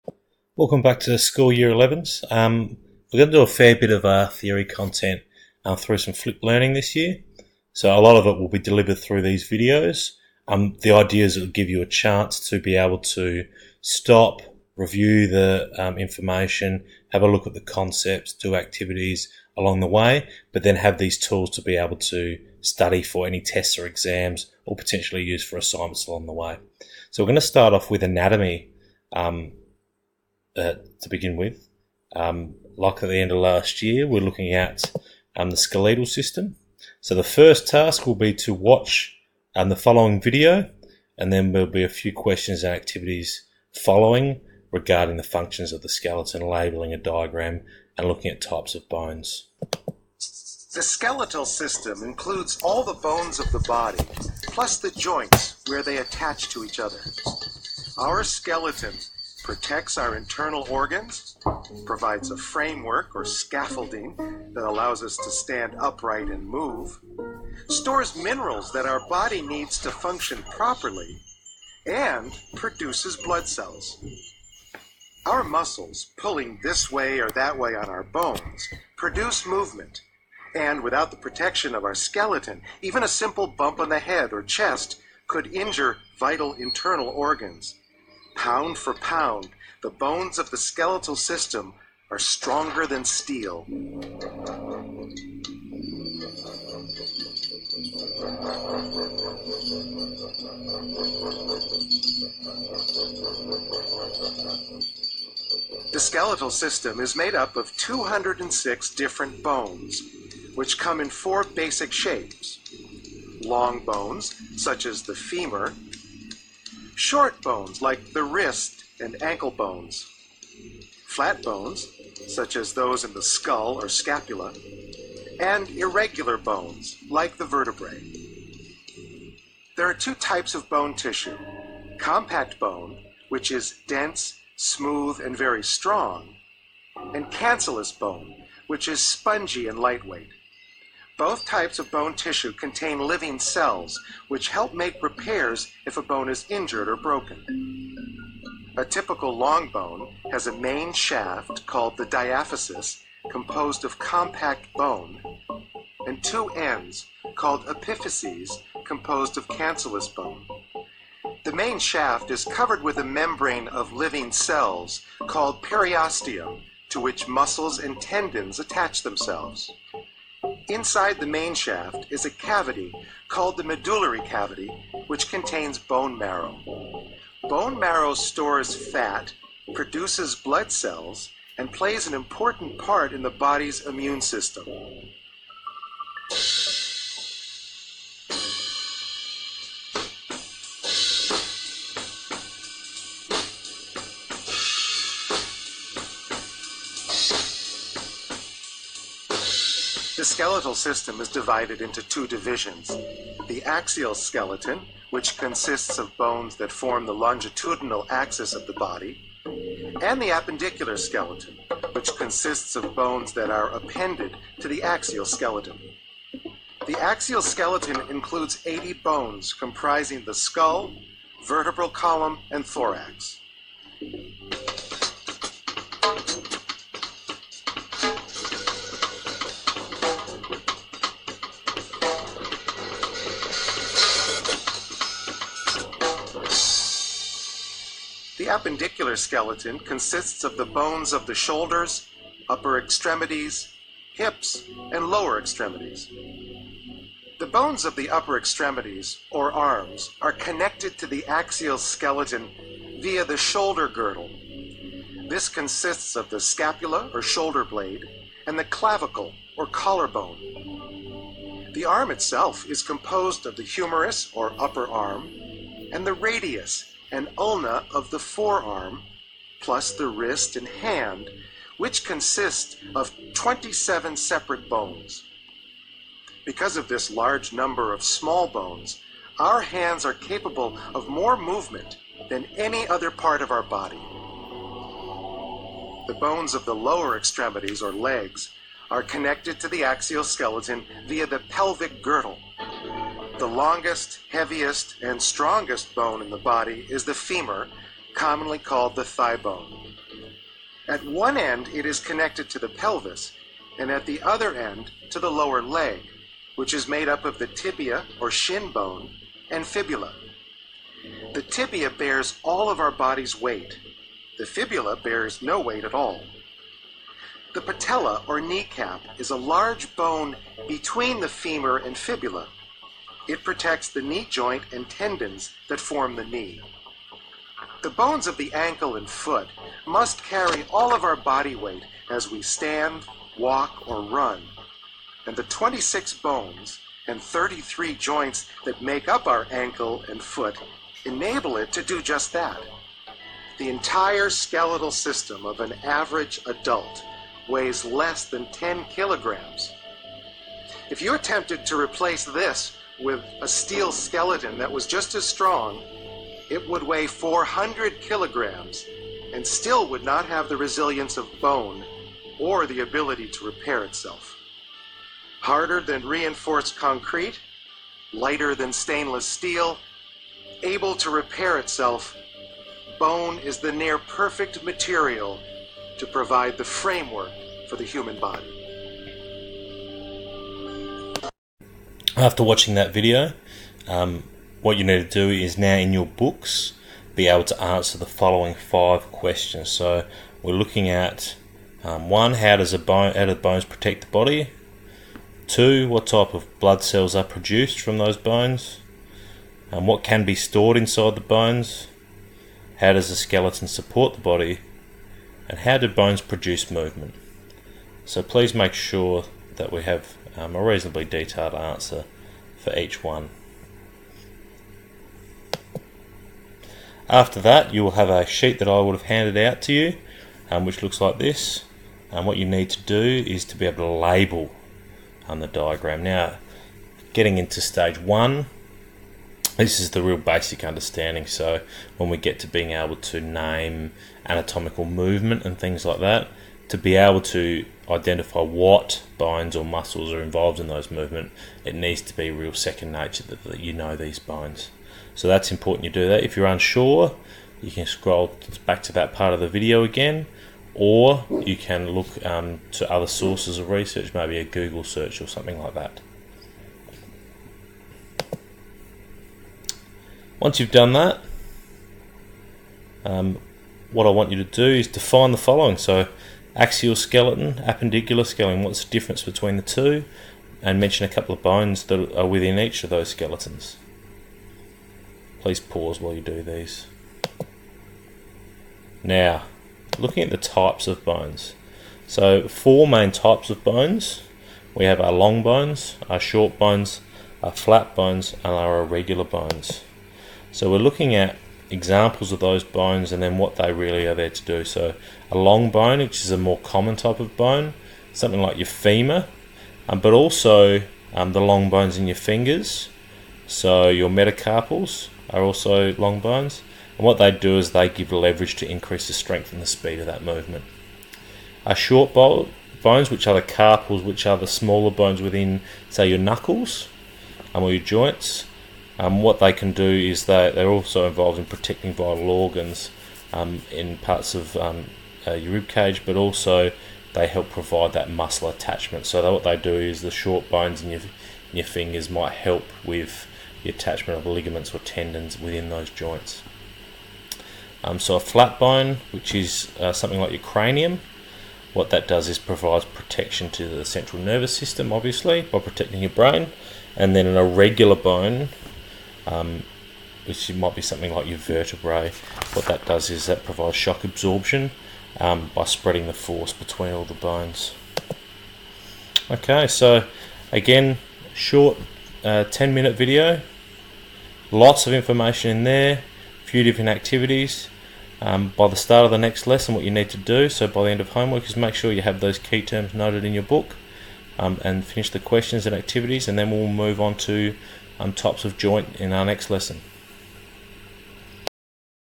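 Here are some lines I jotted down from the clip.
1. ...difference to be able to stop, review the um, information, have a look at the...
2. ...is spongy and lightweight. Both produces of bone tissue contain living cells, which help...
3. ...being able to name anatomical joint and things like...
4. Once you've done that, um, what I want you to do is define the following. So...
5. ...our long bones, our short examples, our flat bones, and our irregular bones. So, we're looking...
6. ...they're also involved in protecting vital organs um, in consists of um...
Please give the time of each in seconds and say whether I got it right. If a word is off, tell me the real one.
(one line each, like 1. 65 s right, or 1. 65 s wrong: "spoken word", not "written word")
1. 11 s wrong: "chance", not "difference"
2. 138 s wrong: "types", not "produces"
3. 432 s wrong: "movement", not "joint"
4. 460 s right
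5. 485 s wrong: "bones", not "examples"
6. 520 s wrong: "parts", not "consists".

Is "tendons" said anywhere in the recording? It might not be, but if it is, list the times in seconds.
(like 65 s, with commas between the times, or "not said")
168 s, 324 s, 534 s.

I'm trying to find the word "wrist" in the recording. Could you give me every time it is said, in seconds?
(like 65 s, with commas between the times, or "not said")
118 s, 270 s.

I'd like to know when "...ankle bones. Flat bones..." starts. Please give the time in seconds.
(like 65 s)
119 s.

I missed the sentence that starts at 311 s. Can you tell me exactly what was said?
The tibia bears all of our body's weight.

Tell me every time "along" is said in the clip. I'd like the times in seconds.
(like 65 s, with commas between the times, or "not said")
19 s, 26 s.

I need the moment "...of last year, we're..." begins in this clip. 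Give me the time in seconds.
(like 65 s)
33 s.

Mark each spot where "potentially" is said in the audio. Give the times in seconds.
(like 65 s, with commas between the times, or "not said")
24 s.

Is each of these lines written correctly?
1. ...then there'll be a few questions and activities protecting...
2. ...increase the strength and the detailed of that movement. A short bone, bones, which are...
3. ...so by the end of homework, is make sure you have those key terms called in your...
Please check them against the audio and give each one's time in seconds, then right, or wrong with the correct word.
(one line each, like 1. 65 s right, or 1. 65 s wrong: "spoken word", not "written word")
1. 41 s wrong: "following", not "protecting"
2. 508 s wrong: "speed", not "detailed"
3. 570 s wrong: "noted", not "called".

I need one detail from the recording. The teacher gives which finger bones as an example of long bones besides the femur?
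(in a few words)
metacarpals.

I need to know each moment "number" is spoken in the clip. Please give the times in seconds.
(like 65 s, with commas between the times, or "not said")
277 s.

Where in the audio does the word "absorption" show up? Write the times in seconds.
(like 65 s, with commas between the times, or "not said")
554 s.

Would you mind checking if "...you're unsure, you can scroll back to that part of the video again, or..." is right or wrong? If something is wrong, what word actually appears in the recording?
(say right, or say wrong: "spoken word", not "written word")
right.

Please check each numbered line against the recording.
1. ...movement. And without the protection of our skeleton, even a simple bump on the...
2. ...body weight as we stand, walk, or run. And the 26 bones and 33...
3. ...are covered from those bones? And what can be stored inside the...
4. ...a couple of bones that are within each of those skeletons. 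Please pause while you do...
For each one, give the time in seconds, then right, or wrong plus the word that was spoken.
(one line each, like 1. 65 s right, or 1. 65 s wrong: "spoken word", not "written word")
1. 79 s right
2. 331 s right
3. 397 s wrong: "produced", not "covered"
4. 471 s right.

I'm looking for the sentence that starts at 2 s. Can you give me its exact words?
Um, we're going to do a fair bit of uh, theory content um, through some flip learning this year.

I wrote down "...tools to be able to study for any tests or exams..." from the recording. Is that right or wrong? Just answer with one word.
right.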